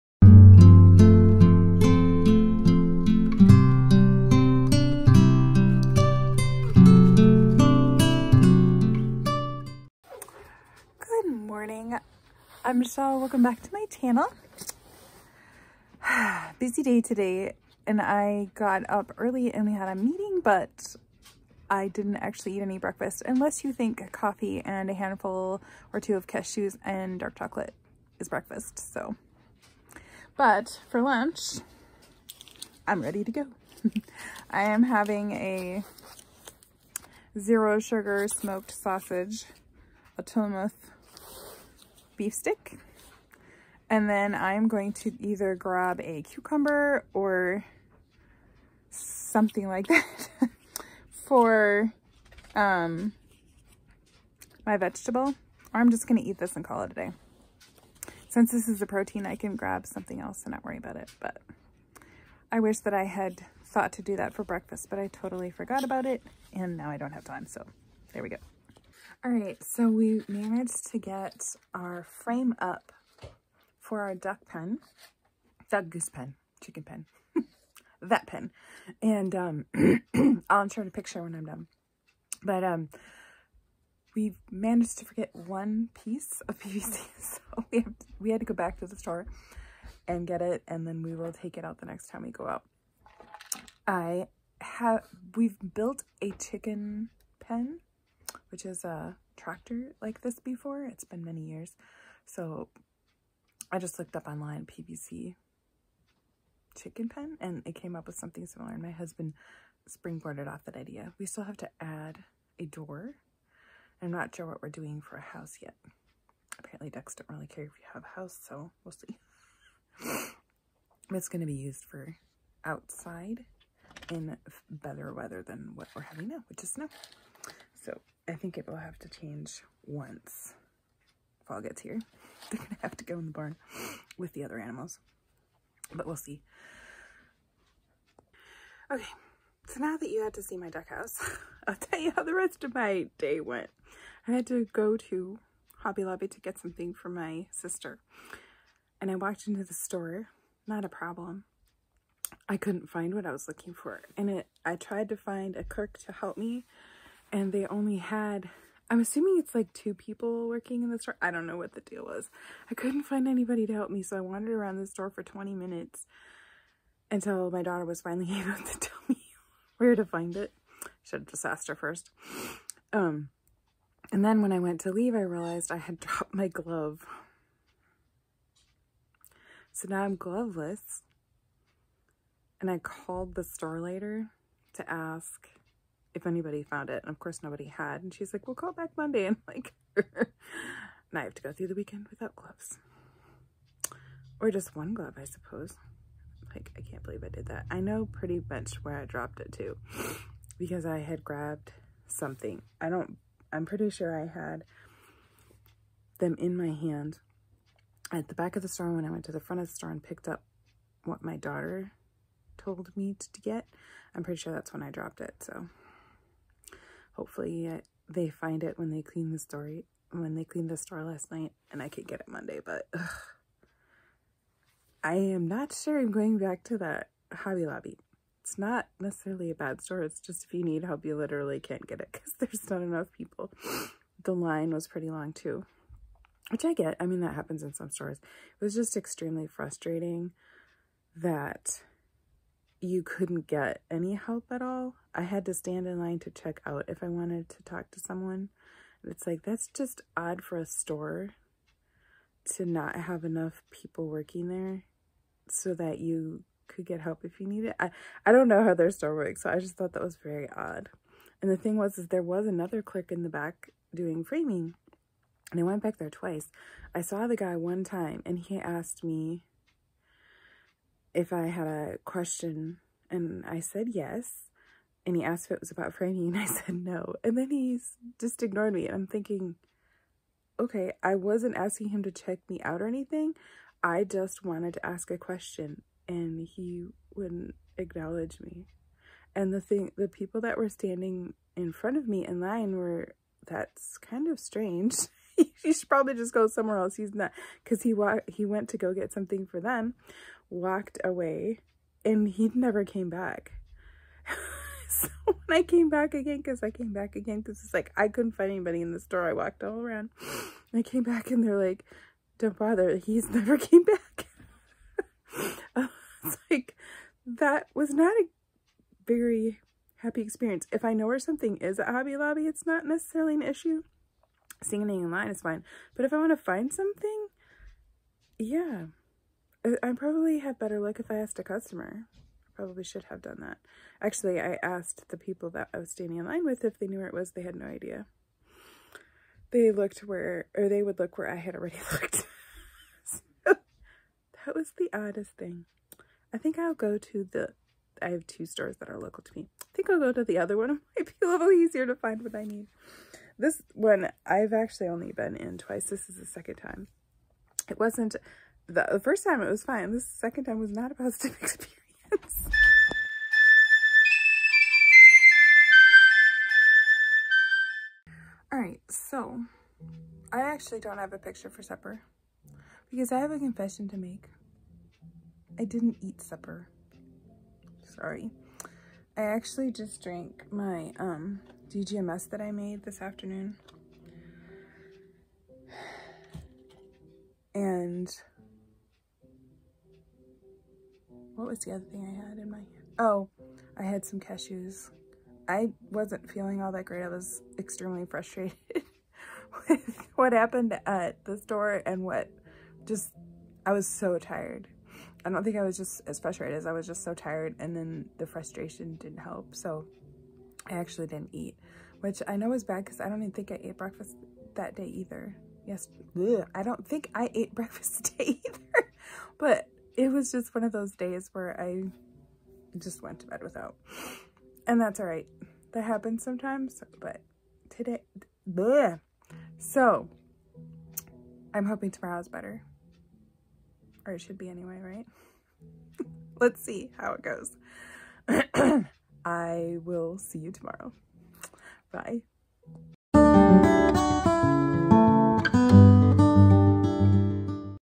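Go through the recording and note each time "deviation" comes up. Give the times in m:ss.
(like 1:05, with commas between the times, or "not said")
not said.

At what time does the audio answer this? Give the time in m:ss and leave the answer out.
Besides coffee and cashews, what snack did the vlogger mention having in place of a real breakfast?
0:27.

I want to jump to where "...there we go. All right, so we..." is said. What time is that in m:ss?
1:08.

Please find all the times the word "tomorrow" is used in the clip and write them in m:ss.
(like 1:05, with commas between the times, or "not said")
7:11, 7:20.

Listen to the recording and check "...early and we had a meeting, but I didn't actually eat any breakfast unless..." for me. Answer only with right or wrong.
right.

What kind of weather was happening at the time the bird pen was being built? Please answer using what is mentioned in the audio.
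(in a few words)
snow.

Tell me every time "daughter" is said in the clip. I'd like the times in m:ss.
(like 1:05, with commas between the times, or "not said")
2:47, 3:31.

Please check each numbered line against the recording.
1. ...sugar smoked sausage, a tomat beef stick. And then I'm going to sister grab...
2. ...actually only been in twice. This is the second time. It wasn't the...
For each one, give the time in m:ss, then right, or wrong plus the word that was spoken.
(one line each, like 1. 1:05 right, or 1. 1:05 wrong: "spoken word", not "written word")
1. 0:37 wrong: "either", not "sister"
2. 5:54 right.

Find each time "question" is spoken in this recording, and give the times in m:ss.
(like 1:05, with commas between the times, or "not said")
4:32, 4:45.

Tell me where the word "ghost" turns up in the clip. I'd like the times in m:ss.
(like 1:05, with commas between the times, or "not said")
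not said.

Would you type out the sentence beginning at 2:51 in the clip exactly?
Should have just asked her first.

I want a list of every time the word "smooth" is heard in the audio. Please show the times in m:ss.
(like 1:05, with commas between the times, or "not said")
not said.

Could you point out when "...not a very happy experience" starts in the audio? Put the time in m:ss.
5:17.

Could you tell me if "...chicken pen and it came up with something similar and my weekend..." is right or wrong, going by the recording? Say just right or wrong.
wrong.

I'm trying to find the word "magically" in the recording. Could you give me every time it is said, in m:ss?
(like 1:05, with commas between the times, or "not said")
not said.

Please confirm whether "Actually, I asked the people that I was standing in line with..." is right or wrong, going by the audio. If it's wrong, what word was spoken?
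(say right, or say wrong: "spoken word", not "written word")
right.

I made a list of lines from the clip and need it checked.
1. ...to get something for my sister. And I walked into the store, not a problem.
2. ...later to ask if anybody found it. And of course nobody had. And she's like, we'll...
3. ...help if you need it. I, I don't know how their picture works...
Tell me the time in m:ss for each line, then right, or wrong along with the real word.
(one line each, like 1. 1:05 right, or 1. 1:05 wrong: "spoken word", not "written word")
1. 2:26 right
2. 3:03 right
3. 4:17 wrong: "store", not "picture".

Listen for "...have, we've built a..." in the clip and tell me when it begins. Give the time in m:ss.
1:34.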